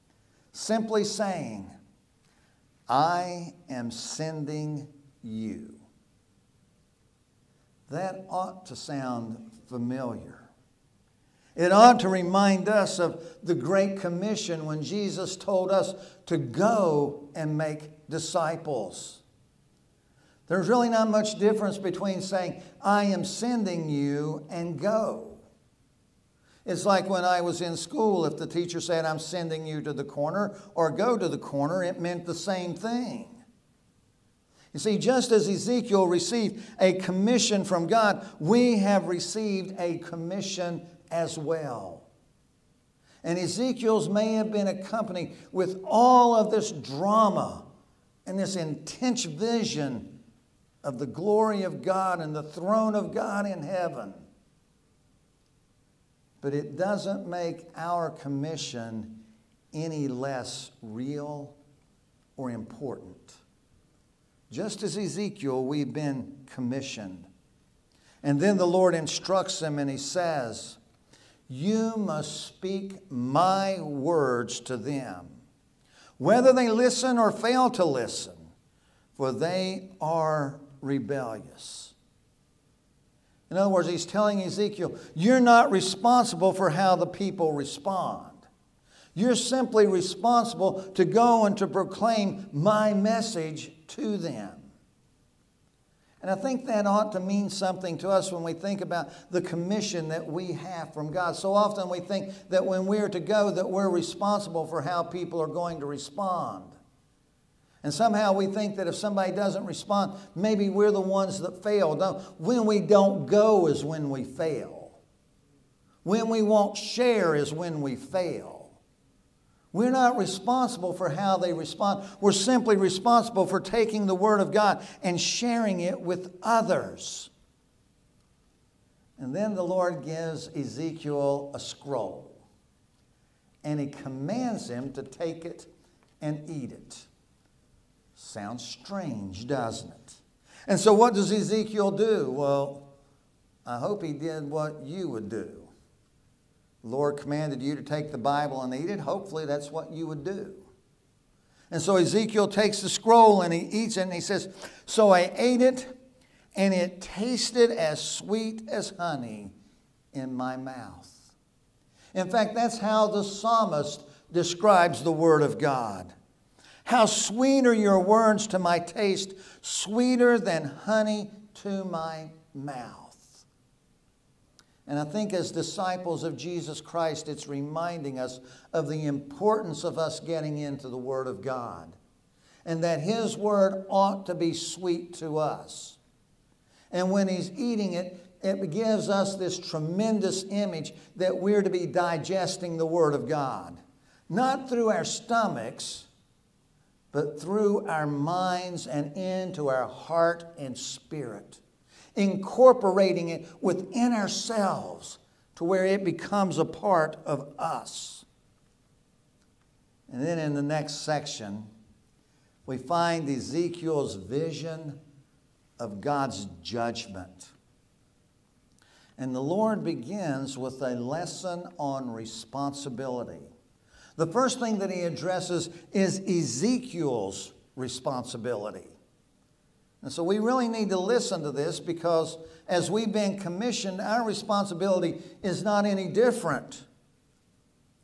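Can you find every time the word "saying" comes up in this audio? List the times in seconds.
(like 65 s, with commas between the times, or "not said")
1 s, 22 s.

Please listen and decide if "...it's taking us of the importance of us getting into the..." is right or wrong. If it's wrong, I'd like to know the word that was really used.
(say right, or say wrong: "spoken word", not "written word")
wrong: "reminding", not "taking".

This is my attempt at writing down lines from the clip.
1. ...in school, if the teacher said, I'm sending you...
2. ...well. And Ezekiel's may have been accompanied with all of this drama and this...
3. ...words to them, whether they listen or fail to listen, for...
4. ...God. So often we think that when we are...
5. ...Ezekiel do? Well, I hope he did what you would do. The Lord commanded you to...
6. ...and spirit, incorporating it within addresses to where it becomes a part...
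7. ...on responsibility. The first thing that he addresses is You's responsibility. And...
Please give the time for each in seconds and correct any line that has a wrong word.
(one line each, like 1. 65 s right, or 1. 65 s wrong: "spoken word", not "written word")
1. 27 s right
2. 41 s right
3. 73 s right
4. 101 s right
5. 141 s right
6. 200 s wrong: "ourselves", not "addresses"
7. 221 s wrong: "Ezekiel", not "You".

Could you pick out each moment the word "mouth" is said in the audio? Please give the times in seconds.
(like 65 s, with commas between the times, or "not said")
160 s, 172 s.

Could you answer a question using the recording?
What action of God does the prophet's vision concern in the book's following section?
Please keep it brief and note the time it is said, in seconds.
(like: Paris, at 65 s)
judgment, at 216 s.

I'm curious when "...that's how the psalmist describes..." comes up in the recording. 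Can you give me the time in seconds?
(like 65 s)
162 s.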